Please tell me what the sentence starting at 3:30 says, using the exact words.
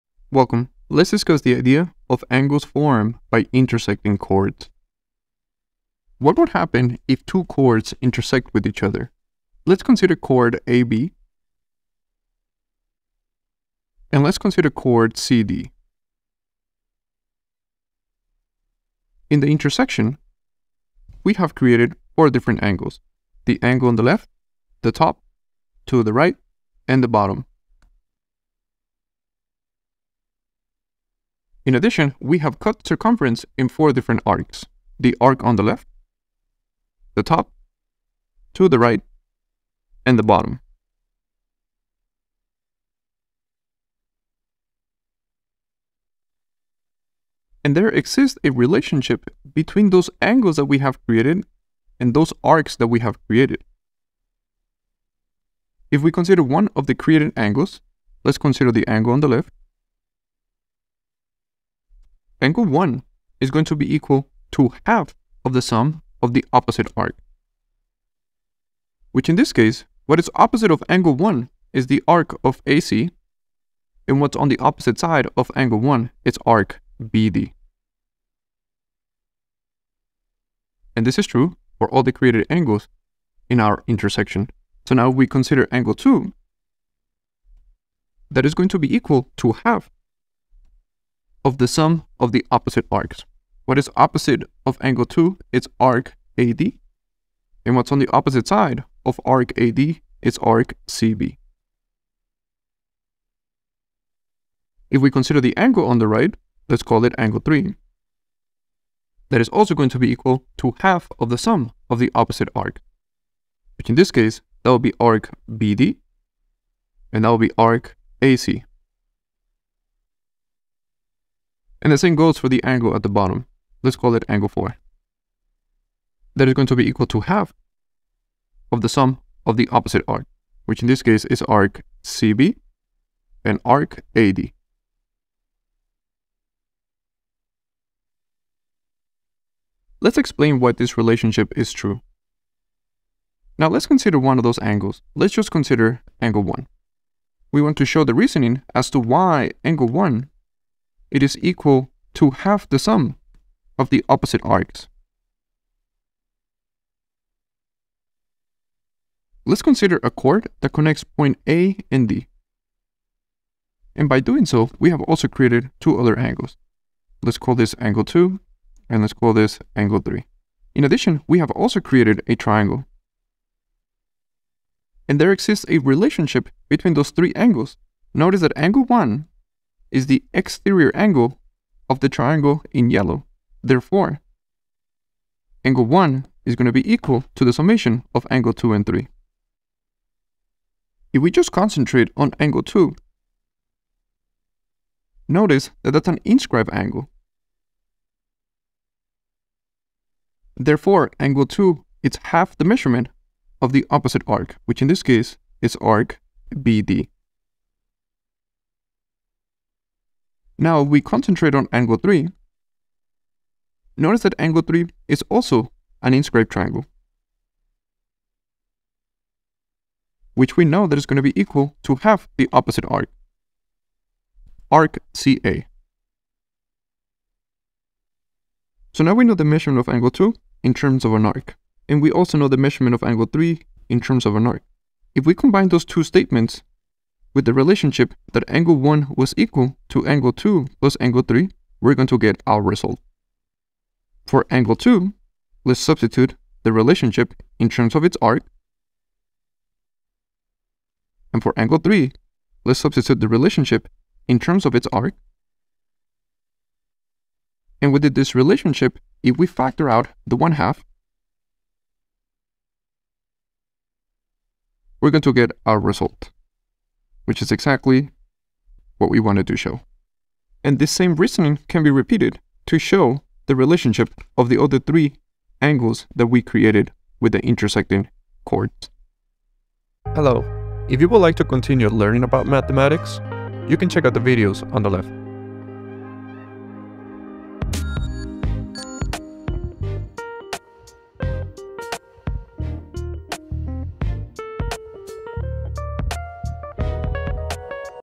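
Now we concentrate on angle 3.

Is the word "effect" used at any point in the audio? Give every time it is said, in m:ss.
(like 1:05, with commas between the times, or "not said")
not said.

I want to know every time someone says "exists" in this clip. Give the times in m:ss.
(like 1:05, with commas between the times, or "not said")
0:47, 2:55.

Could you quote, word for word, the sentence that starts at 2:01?
And the same goes for the angle at the bottom.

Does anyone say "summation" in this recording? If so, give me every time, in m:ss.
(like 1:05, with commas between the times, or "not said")
3:07.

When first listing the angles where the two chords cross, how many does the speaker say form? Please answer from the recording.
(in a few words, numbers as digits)
4.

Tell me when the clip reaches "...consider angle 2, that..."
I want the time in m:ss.
1:25.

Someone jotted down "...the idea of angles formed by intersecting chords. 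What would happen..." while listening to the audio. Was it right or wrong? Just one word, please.
right.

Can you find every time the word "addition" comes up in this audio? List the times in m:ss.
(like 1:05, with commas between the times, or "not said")
0:31, 2:50.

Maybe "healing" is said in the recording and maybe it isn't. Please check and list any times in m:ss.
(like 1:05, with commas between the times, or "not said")
not said.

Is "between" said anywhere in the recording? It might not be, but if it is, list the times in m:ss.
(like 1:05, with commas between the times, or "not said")
0:49, 2:56.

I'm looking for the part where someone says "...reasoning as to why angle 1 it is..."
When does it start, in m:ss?
2:28.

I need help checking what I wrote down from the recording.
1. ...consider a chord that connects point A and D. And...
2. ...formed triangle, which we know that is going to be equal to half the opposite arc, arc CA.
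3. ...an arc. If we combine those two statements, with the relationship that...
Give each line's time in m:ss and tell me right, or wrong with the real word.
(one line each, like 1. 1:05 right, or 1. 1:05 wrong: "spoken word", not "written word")
1. 2:39 right
2. 3:36 wrong: "inscribed", not "formed"
3. 3:54 right.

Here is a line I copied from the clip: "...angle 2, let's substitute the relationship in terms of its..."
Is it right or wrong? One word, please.
right.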